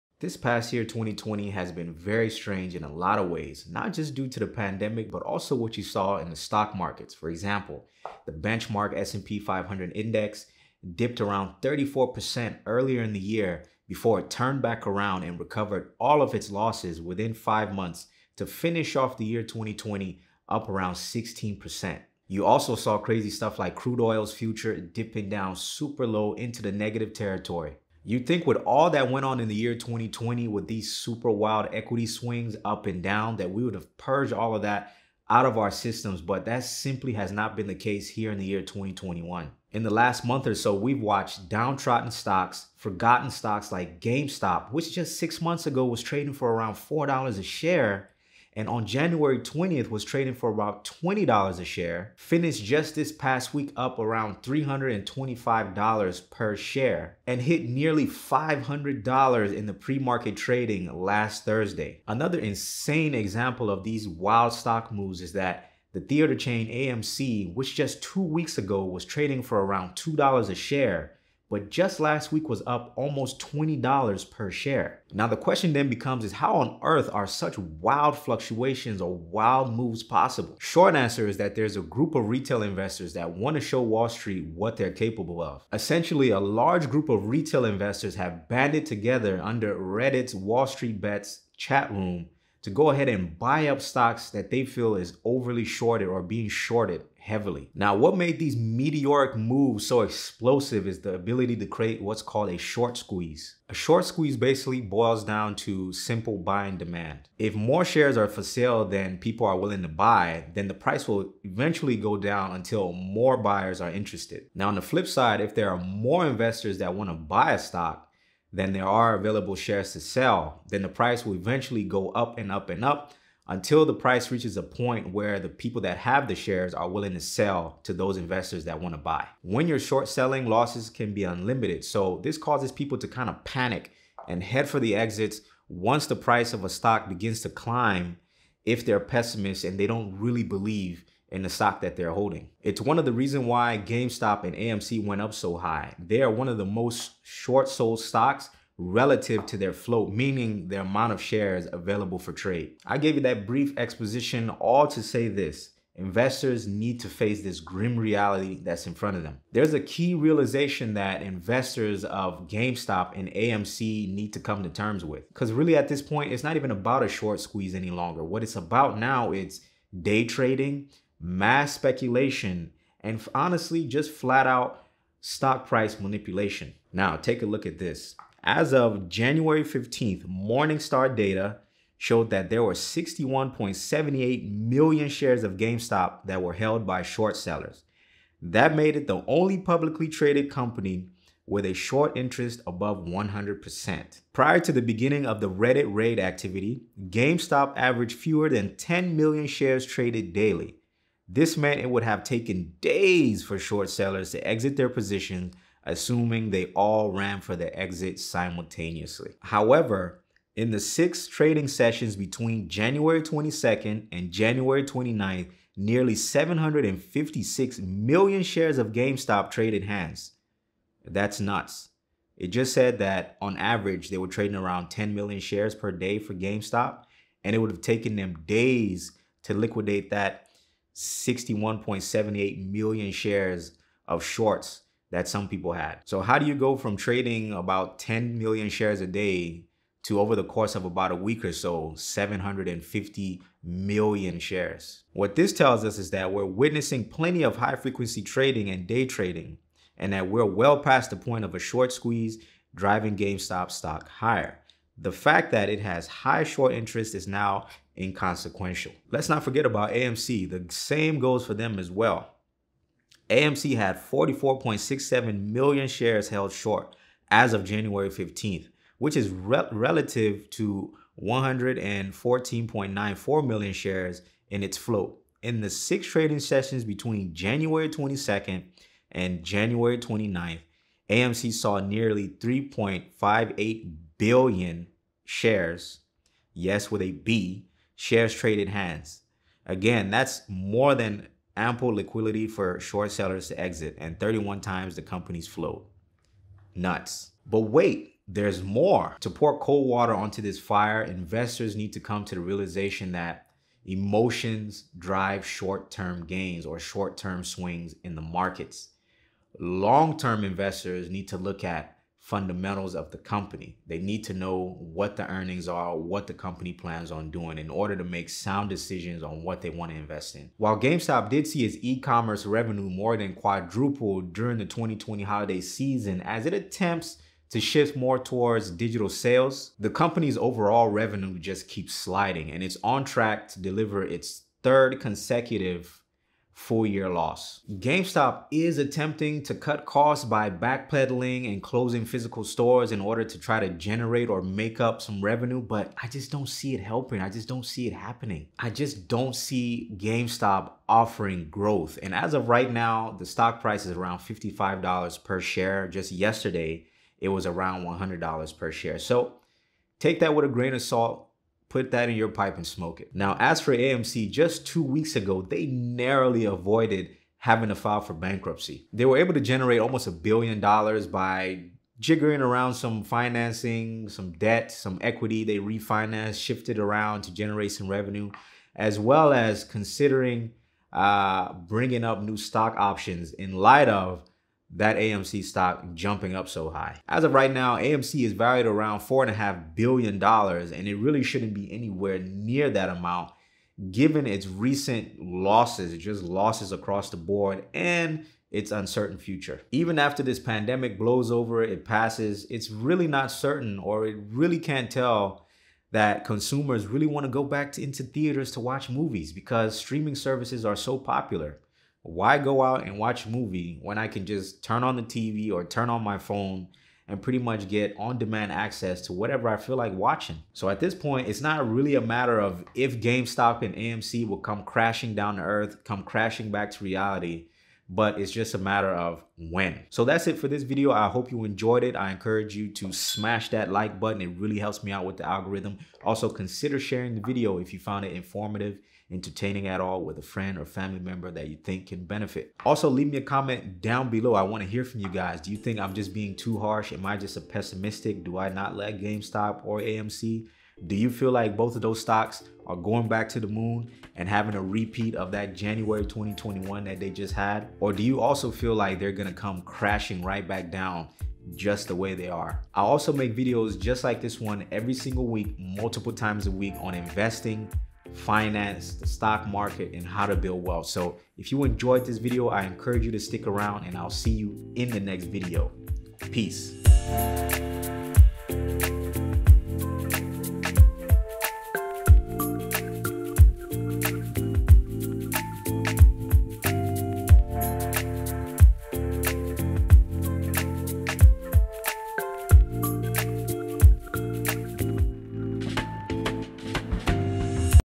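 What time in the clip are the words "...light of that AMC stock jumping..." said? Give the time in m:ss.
6:23.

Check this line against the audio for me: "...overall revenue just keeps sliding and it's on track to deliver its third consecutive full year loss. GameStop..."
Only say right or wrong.
right.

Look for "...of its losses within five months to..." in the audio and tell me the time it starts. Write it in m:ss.
0:16.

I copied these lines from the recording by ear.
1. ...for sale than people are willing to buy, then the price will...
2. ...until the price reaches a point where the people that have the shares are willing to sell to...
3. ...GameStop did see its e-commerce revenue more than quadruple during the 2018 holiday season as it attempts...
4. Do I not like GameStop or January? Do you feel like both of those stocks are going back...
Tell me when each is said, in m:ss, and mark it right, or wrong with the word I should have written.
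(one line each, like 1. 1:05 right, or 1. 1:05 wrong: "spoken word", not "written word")
1. 1:48 right
2. 2:03 right
3. 5:20 wrong: "2020", not "2018"
4. 7:28 wrong: "AMC", not "January".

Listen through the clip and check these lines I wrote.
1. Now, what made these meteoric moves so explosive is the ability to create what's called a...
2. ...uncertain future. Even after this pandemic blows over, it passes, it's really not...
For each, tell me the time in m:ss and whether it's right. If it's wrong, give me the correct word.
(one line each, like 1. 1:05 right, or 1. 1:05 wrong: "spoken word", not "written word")
1. 1:37 right
2. 6:38 right.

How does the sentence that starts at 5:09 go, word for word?
Long term investors need to look at fundamentals of the company.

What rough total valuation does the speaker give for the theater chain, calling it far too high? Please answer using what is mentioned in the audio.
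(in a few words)
$4.5 billion.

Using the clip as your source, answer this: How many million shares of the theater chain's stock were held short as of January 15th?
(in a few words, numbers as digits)
44.67 million.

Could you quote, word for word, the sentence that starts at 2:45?
Because really at this point, it's not even about a short squeeze any longer.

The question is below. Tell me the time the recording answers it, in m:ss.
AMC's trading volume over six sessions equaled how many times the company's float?
4:54.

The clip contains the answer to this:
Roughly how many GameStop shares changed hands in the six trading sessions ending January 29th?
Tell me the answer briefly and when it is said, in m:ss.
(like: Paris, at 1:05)
756 million, at 3:36.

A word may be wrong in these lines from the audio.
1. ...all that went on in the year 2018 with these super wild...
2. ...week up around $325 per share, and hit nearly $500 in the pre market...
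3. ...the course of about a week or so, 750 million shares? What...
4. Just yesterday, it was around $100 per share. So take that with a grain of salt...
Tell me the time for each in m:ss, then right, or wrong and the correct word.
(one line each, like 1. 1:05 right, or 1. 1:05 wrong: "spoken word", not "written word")
1. 0:28 wrong: "2020", not "2018"
2. 0:53 right
3. 4:00 right
4. 5:55 right.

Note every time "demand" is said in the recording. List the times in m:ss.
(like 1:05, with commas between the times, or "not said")
1:46, 6:58.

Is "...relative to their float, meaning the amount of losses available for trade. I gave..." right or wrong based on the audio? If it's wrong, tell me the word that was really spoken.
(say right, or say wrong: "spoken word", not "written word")
wrong: "shares", not "losses".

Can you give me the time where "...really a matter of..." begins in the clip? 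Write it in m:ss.
7:01.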